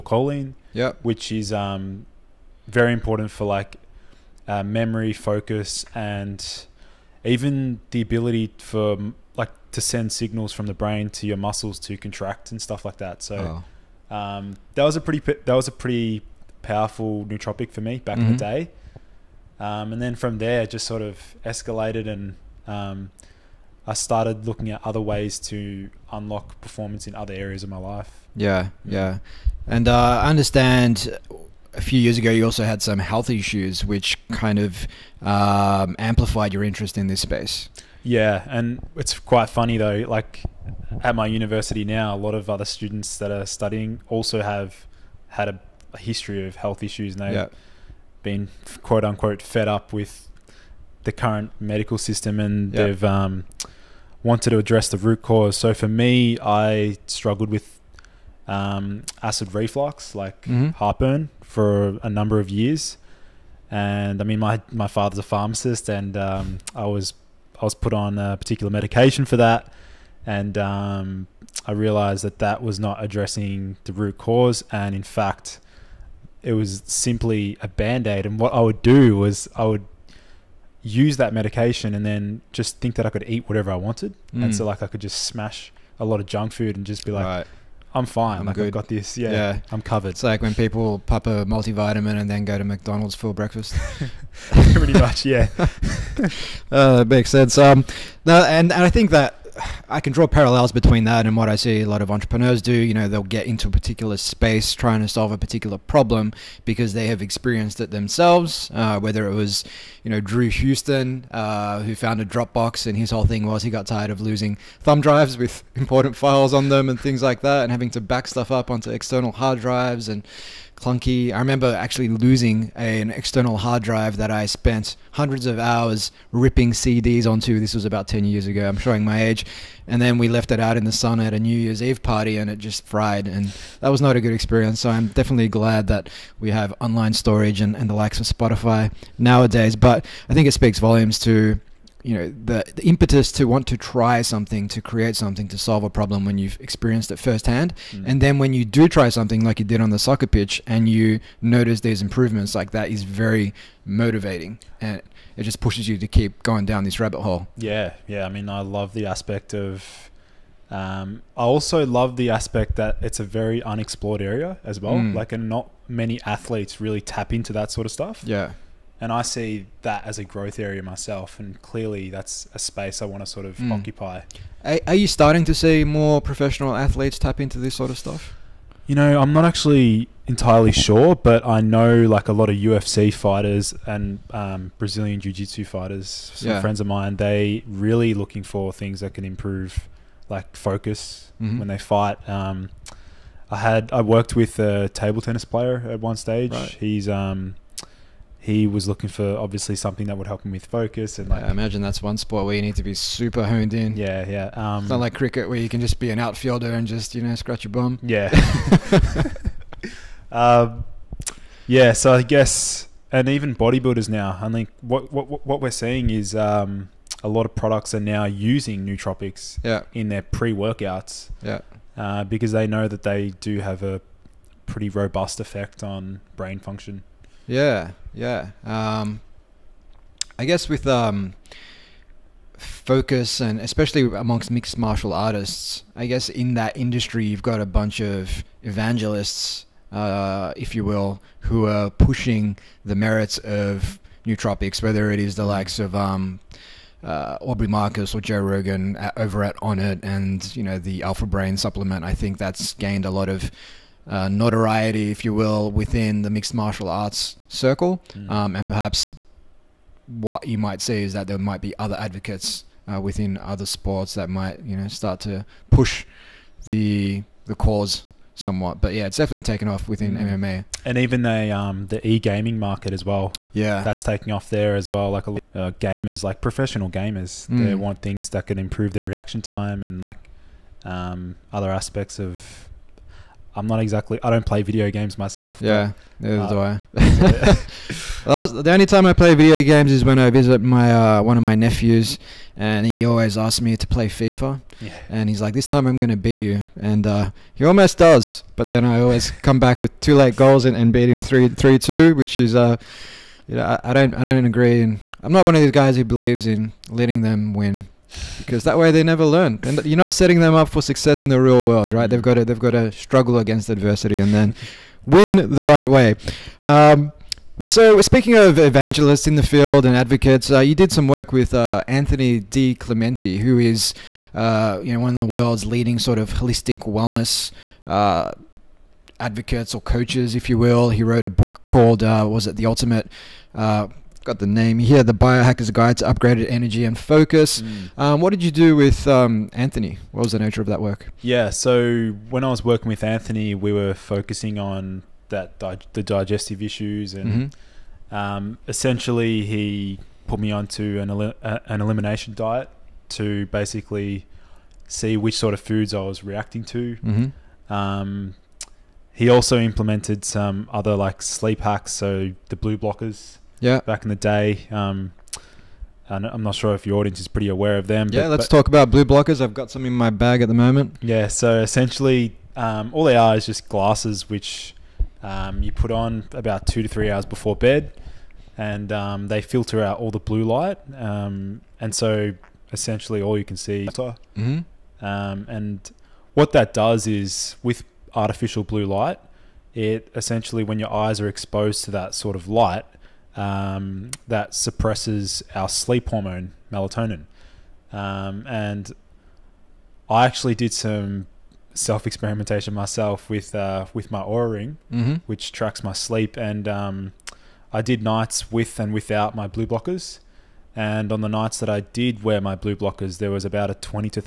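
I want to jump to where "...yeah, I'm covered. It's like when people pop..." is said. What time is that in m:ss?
1:29.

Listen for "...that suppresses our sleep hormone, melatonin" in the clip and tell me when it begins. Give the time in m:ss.
6:34.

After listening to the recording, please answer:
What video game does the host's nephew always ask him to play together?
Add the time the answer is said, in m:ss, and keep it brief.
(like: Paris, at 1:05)
FIFA, at 4:54.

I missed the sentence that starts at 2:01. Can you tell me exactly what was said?
I remember actually losing a, an external hard drive that I spent hundreds of hours ripping CDs onto.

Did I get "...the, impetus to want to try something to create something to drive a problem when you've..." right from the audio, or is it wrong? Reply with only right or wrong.
wrong.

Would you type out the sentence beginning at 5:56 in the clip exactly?
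Mm-hmm um, he also implemented some other like sleep hacks, so the blue blockers yeah.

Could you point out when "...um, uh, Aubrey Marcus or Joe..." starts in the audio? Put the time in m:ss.
4:05.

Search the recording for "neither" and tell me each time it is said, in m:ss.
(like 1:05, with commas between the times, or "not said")
4:46.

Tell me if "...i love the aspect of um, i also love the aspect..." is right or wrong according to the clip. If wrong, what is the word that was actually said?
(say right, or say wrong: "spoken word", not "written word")
right.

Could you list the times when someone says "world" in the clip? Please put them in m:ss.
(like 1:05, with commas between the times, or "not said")
5:11, 5:25.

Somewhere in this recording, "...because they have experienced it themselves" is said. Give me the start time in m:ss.
1:46.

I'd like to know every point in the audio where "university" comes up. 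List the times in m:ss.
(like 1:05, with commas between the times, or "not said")
0:41.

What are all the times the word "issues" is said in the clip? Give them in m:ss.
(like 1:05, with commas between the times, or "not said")
0:33, 0:46, 5:46.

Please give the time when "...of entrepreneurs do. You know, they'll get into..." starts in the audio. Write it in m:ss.
1:42.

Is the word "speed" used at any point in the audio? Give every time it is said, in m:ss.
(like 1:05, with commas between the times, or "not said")
not said.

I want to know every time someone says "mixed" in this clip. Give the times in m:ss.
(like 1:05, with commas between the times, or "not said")
3:54, 4:16.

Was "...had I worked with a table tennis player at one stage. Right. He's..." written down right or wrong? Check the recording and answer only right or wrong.
right.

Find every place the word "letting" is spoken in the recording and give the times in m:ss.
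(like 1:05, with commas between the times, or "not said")
5:06.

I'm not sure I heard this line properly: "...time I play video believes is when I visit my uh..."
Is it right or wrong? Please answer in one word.
wrong.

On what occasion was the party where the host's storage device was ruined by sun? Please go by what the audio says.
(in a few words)
New Year's Eve.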